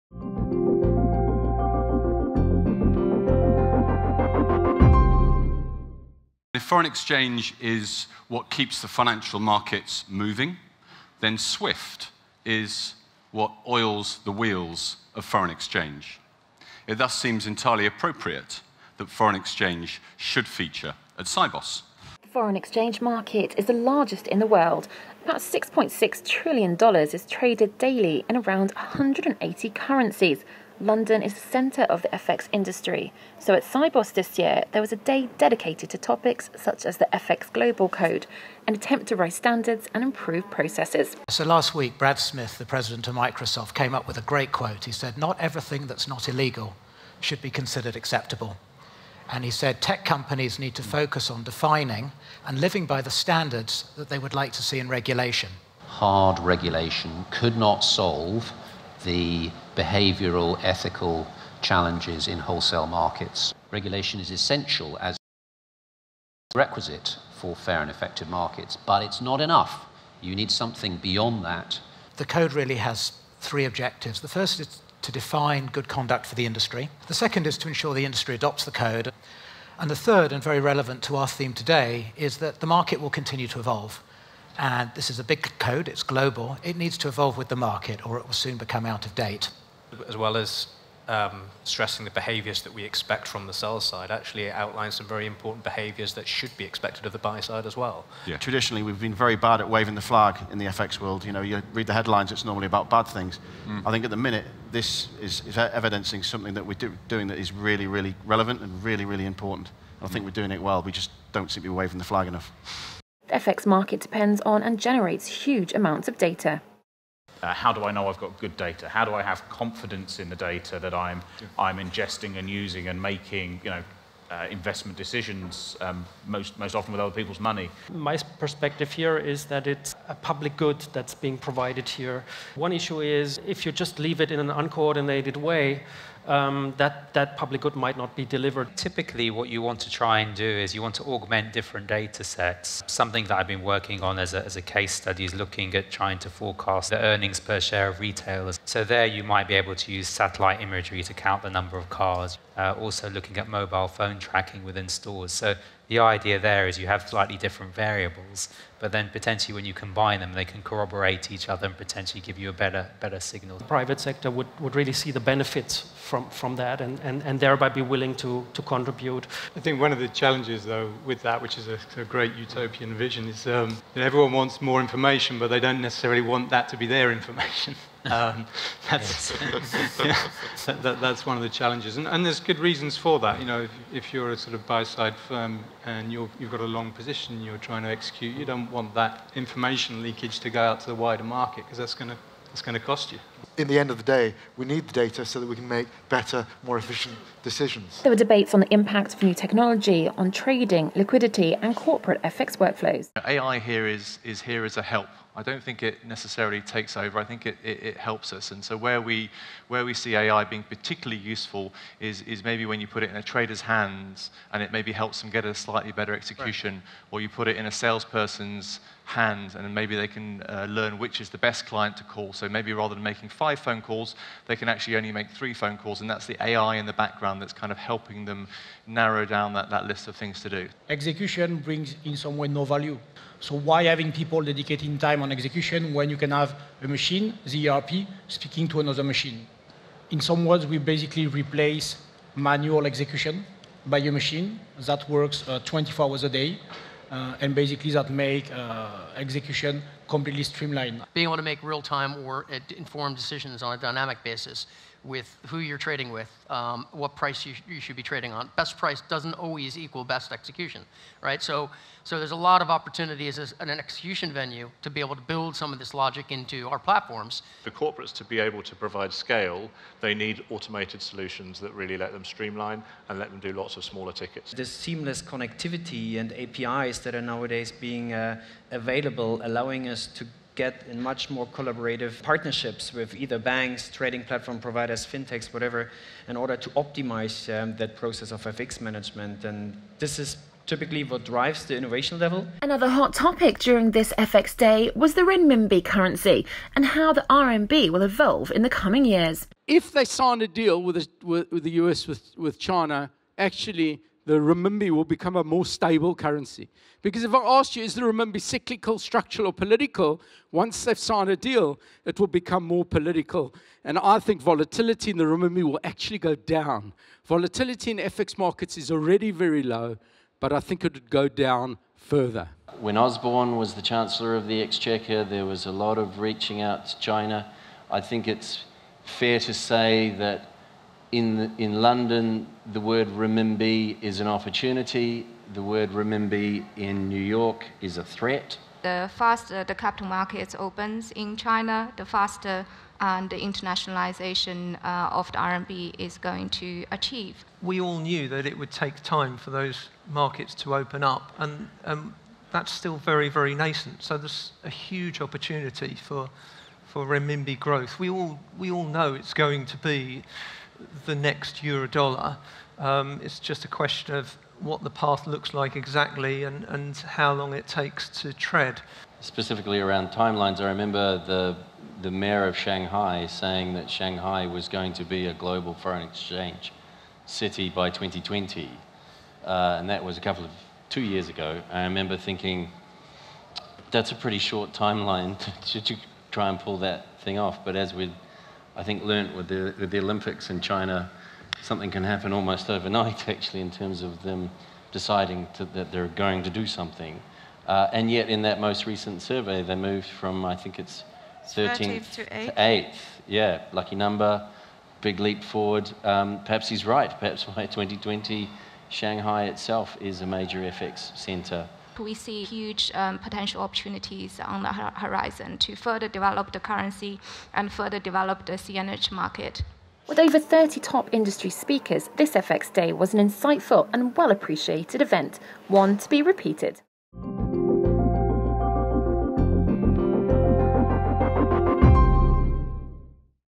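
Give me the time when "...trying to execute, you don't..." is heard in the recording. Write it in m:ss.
3:07.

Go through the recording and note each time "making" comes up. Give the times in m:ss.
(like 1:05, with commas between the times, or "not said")
2:03, 3:43.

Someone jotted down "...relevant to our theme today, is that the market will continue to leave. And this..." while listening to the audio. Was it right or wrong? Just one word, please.
wrong.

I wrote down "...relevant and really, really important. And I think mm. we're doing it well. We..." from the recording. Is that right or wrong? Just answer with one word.
right.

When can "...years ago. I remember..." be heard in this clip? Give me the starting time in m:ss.
6:21.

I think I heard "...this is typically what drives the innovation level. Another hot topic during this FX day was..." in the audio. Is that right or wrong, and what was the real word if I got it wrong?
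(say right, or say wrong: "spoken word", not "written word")
right.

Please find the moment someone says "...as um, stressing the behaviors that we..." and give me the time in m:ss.
1:30.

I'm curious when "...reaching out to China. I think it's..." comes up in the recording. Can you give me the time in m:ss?
5:26.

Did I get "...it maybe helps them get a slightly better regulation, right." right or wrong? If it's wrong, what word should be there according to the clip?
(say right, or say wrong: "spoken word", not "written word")
wrong: "execution", not "regulation".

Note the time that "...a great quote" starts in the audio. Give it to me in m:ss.
0:44.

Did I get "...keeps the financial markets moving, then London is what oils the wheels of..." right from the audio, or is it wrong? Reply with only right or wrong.
wrong.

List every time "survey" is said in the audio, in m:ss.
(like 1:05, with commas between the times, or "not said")
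6:39.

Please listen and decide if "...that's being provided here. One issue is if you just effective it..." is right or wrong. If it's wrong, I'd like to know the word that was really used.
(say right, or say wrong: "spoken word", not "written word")
wrong: "leave", not "effective".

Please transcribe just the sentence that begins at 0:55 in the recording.
Hard regulation could not solve the behavioral, ethical challenges in wholesale markets.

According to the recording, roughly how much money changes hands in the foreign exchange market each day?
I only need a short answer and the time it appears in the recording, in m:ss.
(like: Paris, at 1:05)
$6.6 trillion, at 0:25.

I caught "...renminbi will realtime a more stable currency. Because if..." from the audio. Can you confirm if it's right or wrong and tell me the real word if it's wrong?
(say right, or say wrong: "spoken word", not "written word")
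wrong: "become", not "realtime".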